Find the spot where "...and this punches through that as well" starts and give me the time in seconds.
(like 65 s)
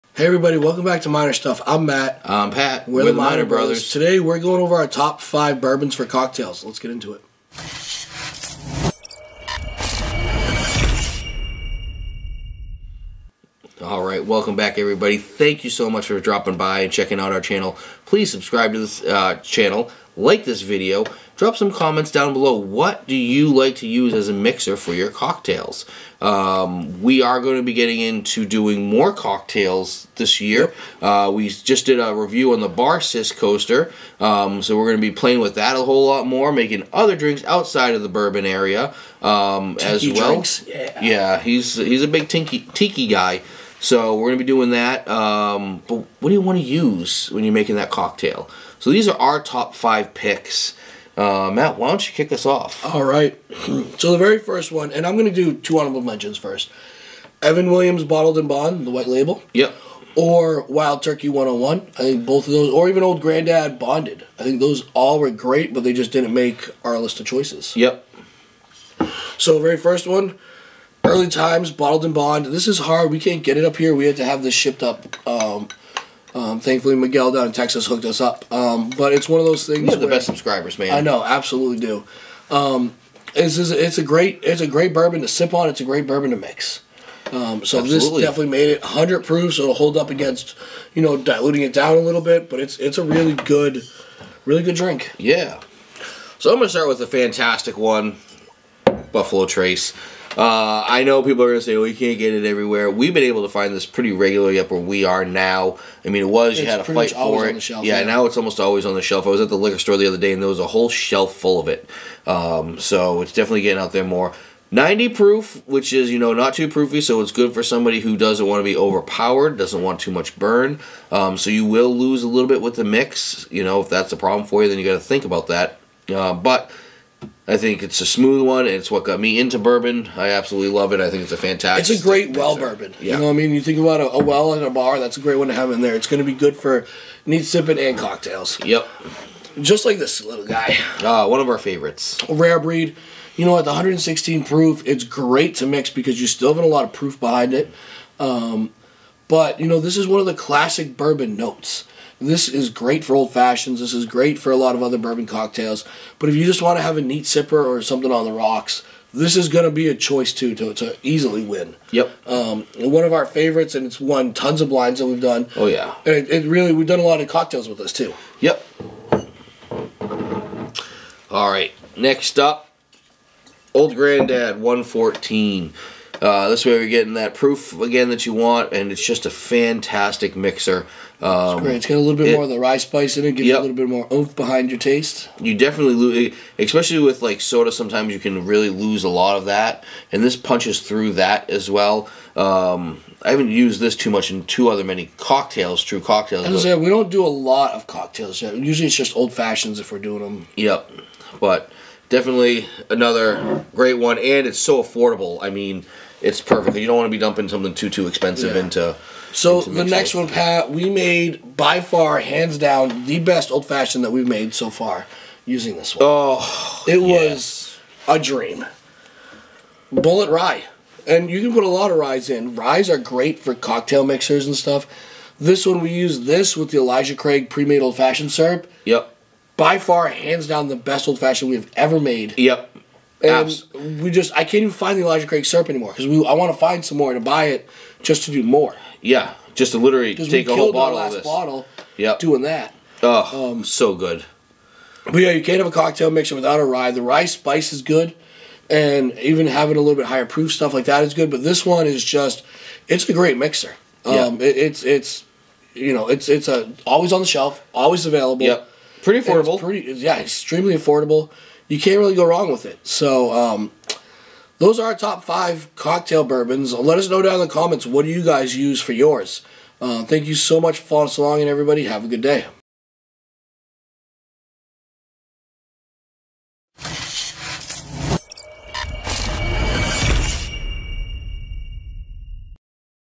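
190 s.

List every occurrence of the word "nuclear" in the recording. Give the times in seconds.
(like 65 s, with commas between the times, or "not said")
not said.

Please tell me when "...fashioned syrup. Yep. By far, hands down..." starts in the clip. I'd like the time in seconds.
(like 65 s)
227 s.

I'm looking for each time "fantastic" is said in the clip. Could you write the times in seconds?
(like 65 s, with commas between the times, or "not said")
97 s, 131 s, 179 s.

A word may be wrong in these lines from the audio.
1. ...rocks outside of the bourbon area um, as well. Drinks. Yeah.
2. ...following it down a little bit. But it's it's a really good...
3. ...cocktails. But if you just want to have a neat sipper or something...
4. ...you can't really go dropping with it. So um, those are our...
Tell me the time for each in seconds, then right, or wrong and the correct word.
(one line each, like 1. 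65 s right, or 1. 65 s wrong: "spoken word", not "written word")
1. 37 s wrong: "drinks", not "rocks"
2. 91 s wrong: "diluting", not "following"
3. 155 s right
4. 261 s wrong: "wrong", not "dropping".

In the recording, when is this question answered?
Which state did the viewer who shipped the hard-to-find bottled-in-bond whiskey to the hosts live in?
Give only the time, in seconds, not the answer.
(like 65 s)
77 s.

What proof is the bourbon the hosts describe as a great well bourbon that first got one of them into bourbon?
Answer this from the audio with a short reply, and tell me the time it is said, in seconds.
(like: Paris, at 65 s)
90, at 114 s.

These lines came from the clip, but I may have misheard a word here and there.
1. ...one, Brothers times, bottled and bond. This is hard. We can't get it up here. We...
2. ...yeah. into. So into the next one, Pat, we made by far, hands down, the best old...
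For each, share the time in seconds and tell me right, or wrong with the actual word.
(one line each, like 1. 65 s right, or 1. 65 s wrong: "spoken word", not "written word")
1. 70 s wrong: "Early", not "Brothers"
2. 208 s right.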